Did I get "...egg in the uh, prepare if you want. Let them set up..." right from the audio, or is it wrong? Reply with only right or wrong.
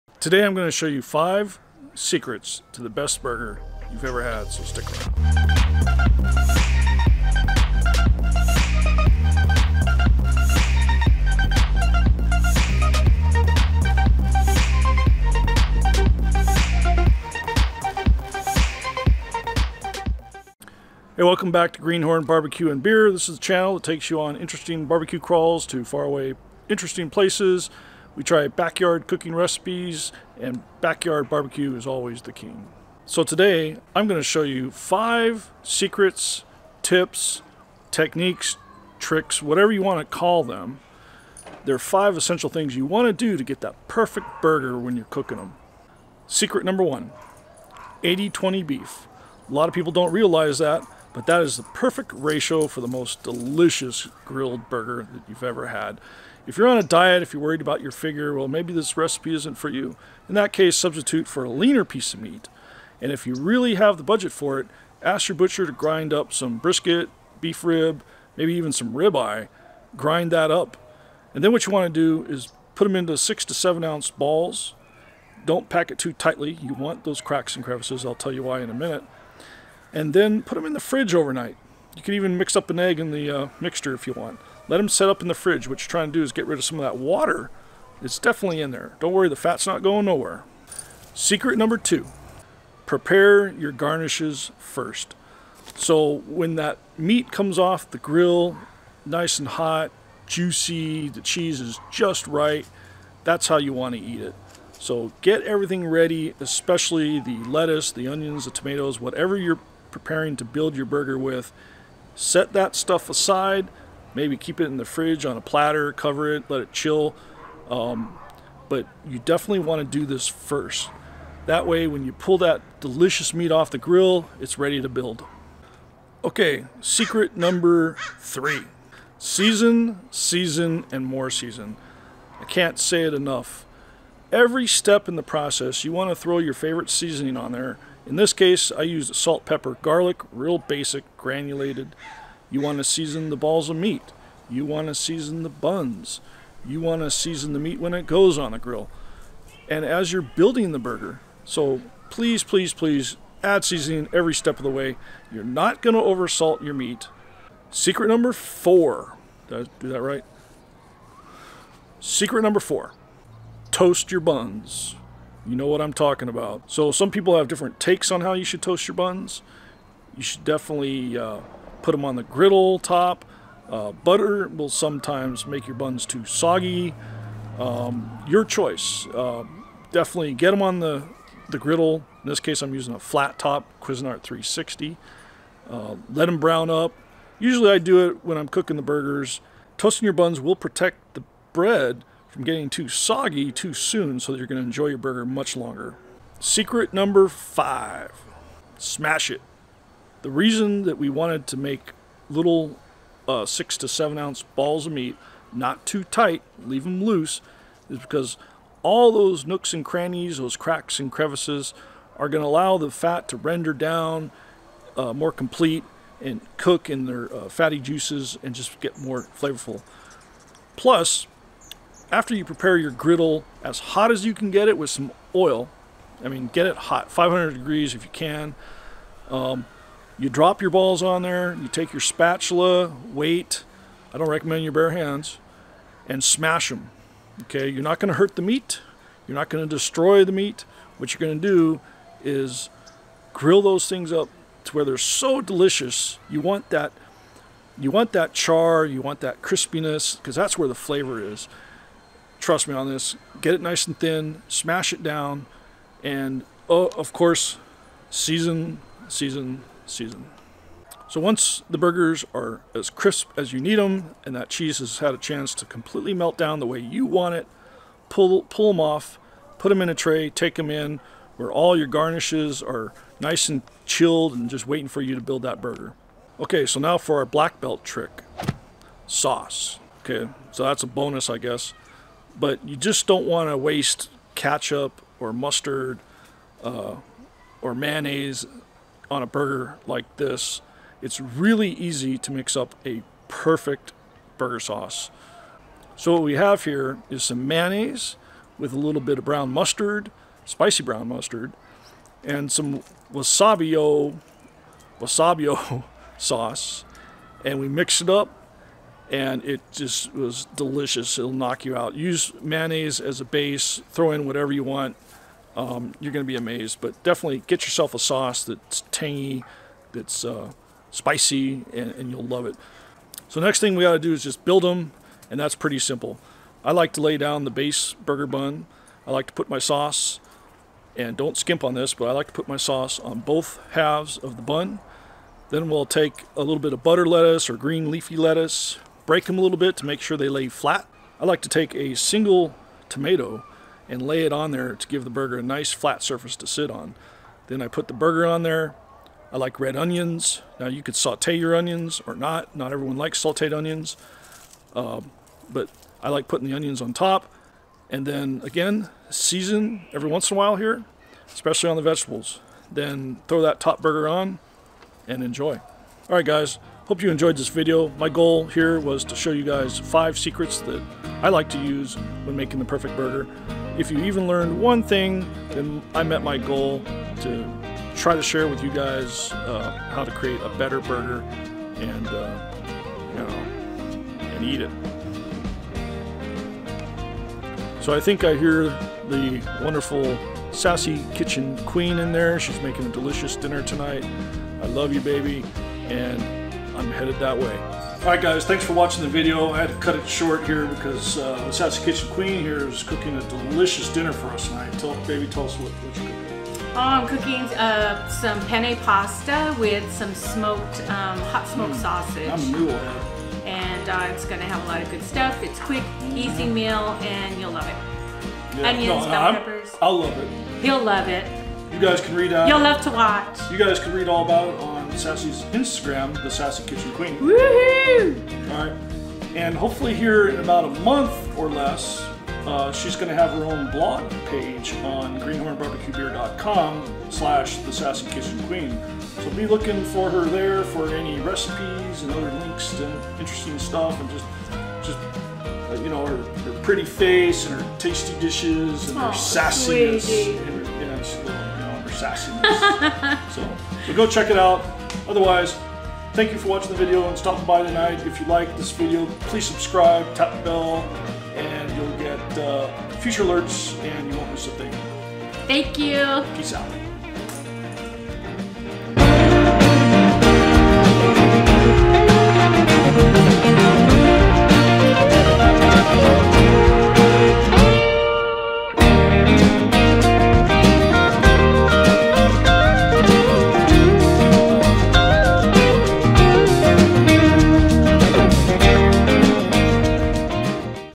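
wrong.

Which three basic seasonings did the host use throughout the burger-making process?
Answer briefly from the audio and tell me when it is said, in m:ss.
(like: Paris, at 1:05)
Salt, pepper, garlic, at 2:19.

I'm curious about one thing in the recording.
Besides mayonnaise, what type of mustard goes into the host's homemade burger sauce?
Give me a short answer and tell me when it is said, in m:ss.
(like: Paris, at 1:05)
Spicy brown mustard, at 5:00.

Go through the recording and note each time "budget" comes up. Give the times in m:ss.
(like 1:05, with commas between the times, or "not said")
1:04.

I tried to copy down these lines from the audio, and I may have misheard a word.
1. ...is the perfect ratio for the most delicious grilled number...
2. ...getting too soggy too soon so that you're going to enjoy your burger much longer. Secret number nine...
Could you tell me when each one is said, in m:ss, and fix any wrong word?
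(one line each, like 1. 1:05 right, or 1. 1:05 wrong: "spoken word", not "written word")
1. 0:51 wrong: "burger", not "number"
2. 3:12 wrong: "five", not "nine".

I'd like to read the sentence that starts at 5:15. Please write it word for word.
Um, you're going to be amazed.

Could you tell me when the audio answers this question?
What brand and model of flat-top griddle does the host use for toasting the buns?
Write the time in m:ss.
3:03.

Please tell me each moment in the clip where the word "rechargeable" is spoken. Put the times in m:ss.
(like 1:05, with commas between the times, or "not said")
not said.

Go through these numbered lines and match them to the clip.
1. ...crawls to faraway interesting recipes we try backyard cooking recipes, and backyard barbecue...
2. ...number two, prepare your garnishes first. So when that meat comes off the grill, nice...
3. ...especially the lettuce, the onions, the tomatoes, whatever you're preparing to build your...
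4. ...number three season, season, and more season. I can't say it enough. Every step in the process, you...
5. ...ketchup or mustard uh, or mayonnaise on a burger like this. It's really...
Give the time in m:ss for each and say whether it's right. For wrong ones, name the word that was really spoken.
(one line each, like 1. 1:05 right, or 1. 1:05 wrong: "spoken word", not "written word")
1. 0:25 wrong: "places", not "recipes"
2. 1:31 right
3. 1:46 right
4. 2:07 right
5. 4:44 right.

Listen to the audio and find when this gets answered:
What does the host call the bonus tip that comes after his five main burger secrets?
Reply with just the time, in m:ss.
4:37.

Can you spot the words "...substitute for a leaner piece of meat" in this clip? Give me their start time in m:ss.
1:00.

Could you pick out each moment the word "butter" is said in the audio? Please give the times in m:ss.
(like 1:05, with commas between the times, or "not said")
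2:53, 5:36.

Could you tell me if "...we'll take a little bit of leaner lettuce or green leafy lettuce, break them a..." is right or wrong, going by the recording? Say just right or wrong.
wrong.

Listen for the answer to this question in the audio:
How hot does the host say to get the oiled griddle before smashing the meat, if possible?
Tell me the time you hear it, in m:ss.
3:47.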